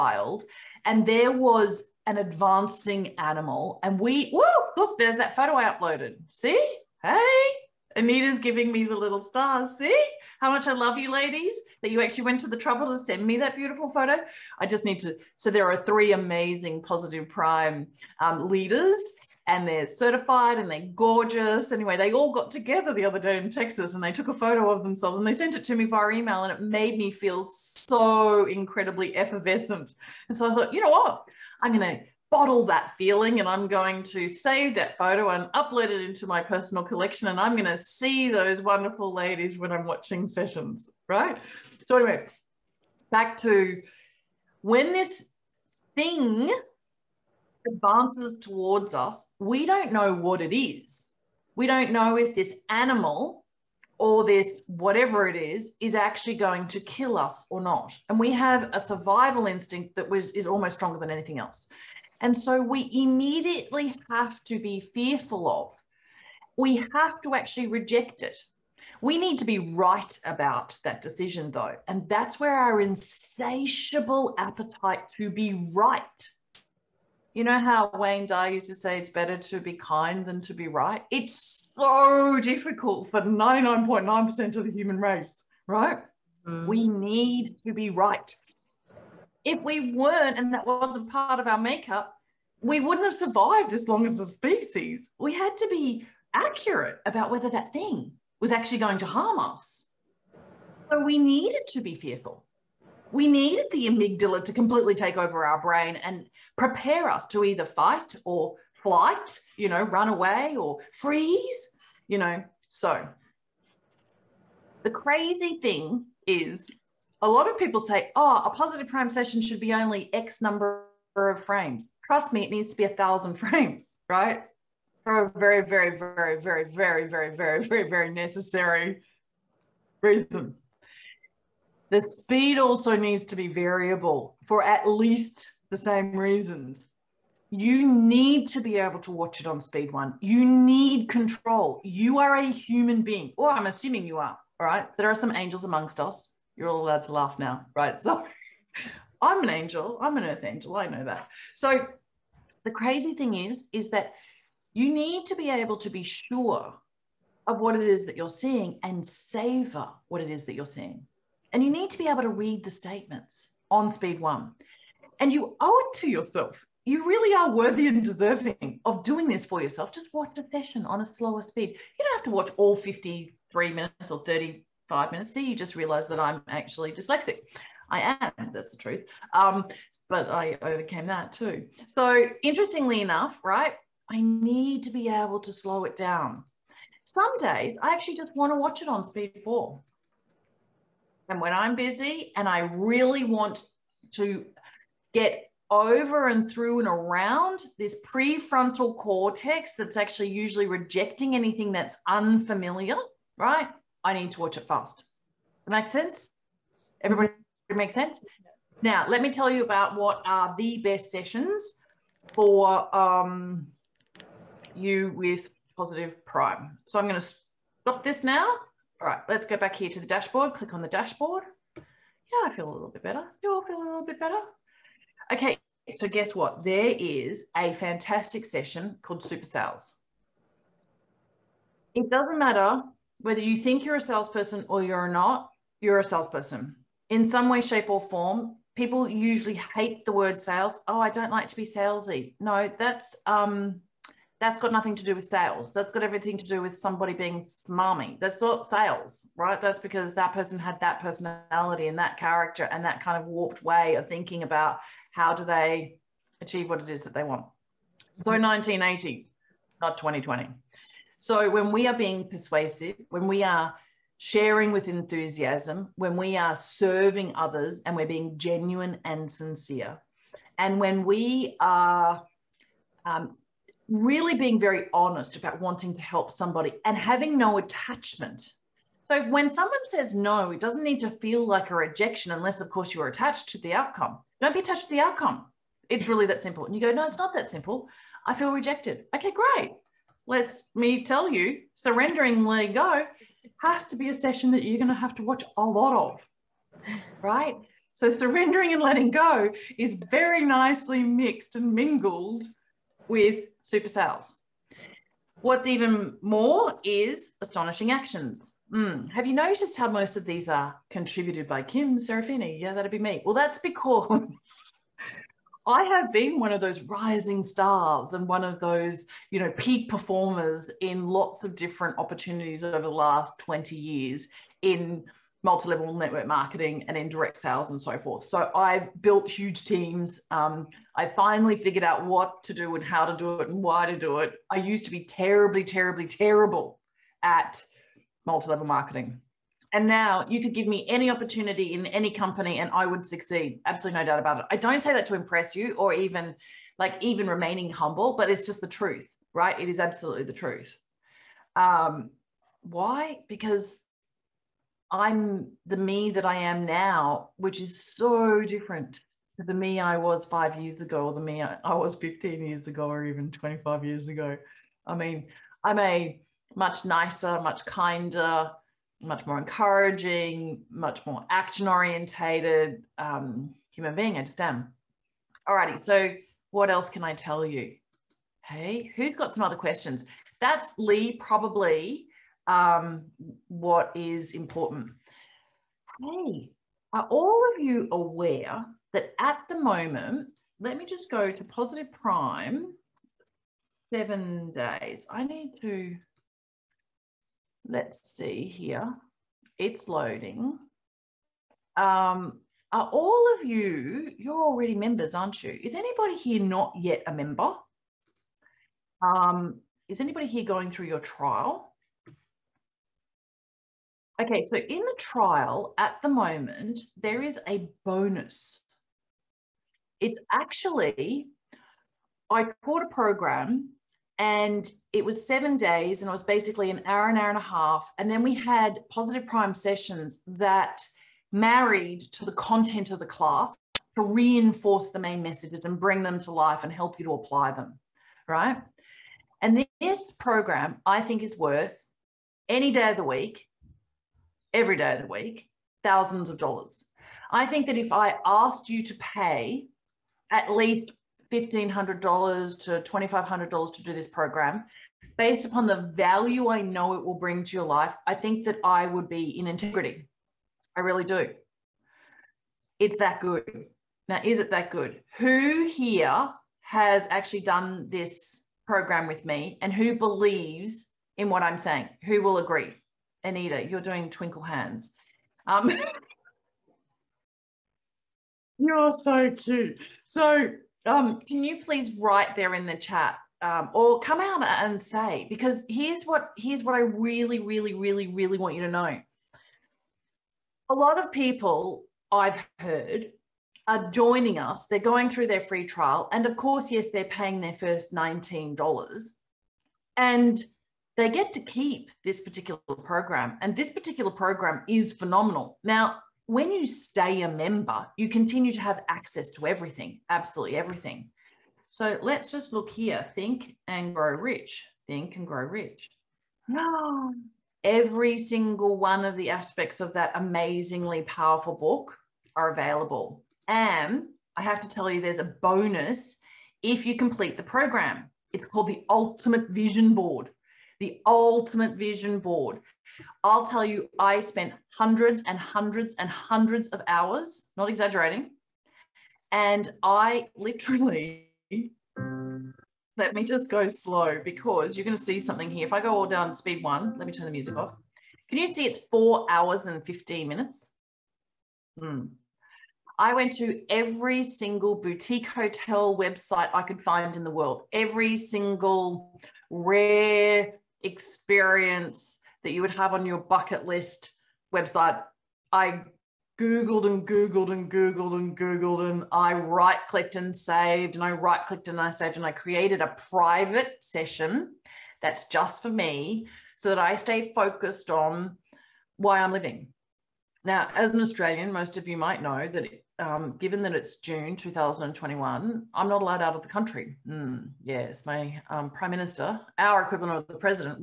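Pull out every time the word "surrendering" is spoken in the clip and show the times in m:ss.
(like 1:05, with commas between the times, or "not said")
4:51, 4:58.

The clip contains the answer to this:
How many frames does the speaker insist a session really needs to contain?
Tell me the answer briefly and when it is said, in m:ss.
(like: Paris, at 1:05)
1000, at 2:02.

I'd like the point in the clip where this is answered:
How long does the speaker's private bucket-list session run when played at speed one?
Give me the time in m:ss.
9:08.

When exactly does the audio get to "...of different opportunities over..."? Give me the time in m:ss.
5:21.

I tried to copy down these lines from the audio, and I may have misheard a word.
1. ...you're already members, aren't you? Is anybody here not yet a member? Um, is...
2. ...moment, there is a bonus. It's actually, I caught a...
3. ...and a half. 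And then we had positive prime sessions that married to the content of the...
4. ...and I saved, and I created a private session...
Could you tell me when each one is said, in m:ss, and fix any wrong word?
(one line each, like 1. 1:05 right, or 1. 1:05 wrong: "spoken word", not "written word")
1. 6:44 right
2. 6:56 right
3. 7:07 right
4. 9:31 right.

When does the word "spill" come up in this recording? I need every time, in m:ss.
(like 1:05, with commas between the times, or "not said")
not said.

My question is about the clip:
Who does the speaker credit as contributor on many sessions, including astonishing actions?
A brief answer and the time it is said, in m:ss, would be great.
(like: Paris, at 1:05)
Kim Serafini, at 5:11.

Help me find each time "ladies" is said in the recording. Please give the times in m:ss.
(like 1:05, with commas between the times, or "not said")
0:11, 0:39.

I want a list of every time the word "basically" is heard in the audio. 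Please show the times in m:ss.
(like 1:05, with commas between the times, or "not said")
7:06.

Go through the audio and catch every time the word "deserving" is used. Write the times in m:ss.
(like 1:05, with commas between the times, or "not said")
2:48.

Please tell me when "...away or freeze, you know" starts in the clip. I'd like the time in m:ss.
1:50.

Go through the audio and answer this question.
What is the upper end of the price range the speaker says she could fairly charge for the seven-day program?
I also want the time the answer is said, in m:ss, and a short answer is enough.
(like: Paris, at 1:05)
$2,500, at 7:32.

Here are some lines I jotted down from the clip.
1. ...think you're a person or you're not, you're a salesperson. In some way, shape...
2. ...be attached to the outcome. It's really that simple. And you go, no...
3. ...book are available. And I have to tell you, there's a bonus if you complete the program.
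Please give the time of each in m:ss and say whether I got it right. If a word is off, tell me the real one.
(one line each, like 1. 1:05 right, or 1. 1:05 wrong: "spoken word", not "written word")
1. 3:53 wrong: "salesperson", not "person"
2. 4:44 right
3. 8:41 right.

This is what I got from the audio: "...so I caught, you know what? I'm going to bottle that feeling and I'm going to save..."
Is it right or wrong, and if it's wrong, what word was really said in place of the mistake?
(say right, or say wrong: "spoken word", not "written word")
wrong: "thought", not "caught".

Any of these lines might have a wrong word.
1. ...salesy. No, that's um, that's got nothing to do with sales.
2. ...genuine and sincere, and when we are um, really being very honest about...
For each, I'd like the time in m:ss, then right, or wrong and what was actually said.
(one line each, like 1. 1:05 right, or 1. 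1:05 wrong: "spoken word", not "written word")
1. 4:01 right
2. 4:28 right.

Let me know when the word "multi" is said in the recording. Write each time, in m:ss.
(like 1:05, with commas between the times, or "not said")
5:25, 5:38.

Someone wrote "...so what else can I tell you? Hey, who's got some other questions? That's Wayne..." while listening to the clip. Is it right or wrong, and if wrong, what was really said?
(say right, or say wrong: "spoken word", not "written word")
wrong: "Lee", not "Wayne".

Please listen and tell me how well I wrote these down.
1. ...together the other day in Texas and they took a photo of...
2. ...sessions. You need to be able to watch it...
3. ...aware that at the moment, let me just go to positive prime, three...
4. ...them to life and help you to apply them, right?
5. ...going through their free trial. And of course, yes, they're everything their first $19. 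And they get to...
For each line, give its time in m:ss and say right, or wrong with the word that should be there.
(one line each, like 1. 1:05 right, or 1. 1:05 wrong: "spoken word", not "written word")
1. 0:22 right
2. 2:16 wrong: "reasons", not "sessions"
3. 6:27 wrong: "seven", not "three"
4. 7:16 right
5. 8:14 wrong: "paying", not "everything".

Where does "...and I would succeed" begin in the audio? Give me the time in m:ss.
5:42.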